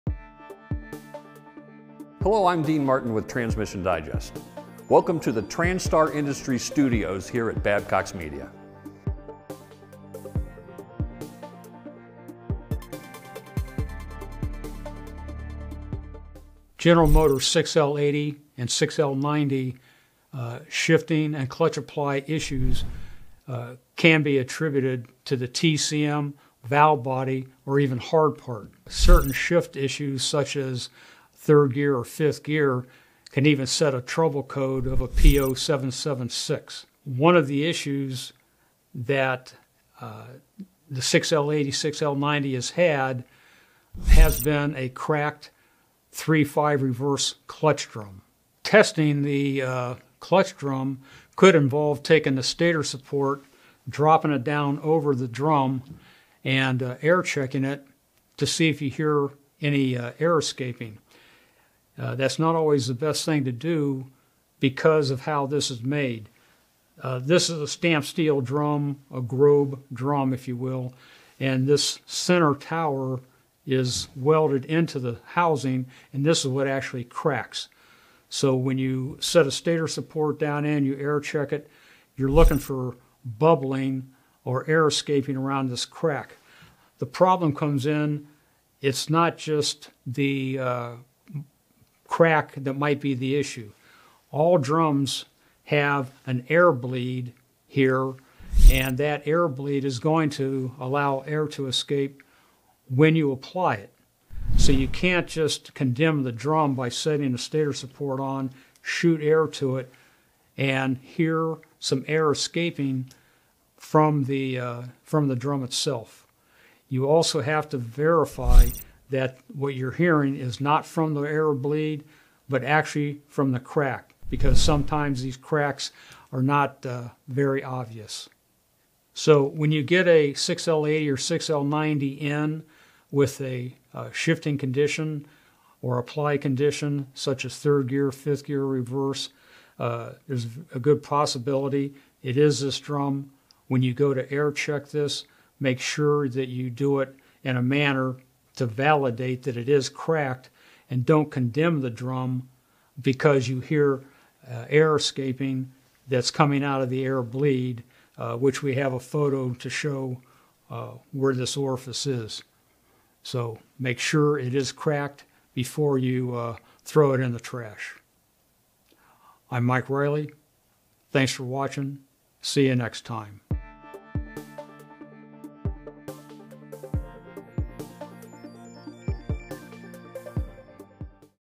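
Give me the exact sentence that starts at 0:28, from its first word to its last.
Certain shift issues such as third gear or fifth gear, can even set a trouble code of a PO 776.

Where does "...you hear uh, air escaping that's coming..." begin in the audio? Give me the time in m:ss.
2:33.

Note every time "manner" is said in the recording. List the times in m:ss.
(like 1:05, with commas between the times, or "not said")
2:27.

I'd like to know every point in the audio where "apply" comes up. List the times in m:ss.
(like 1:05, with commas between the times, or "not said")
0:21, 1:43, 2:15.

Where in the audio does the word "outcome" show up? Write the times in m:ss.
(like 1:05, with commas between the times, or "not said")
not said.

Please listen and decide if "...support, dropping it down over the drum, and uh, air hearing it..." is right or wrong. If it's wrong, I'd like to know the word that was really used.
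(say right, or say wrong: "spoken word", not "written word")
wrong: "checking", not "hearing".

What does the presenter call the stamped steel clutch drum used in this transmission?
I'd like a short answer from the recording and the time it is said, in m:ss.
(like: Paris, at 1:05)
Grob drum, at 1:09.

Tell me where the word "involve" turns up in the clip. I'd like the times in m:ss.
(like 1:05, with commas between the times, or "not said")
0:51.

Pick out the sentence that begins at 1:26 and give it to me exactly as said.
The problem comes in, it's not just the uh, crack that might be the issue.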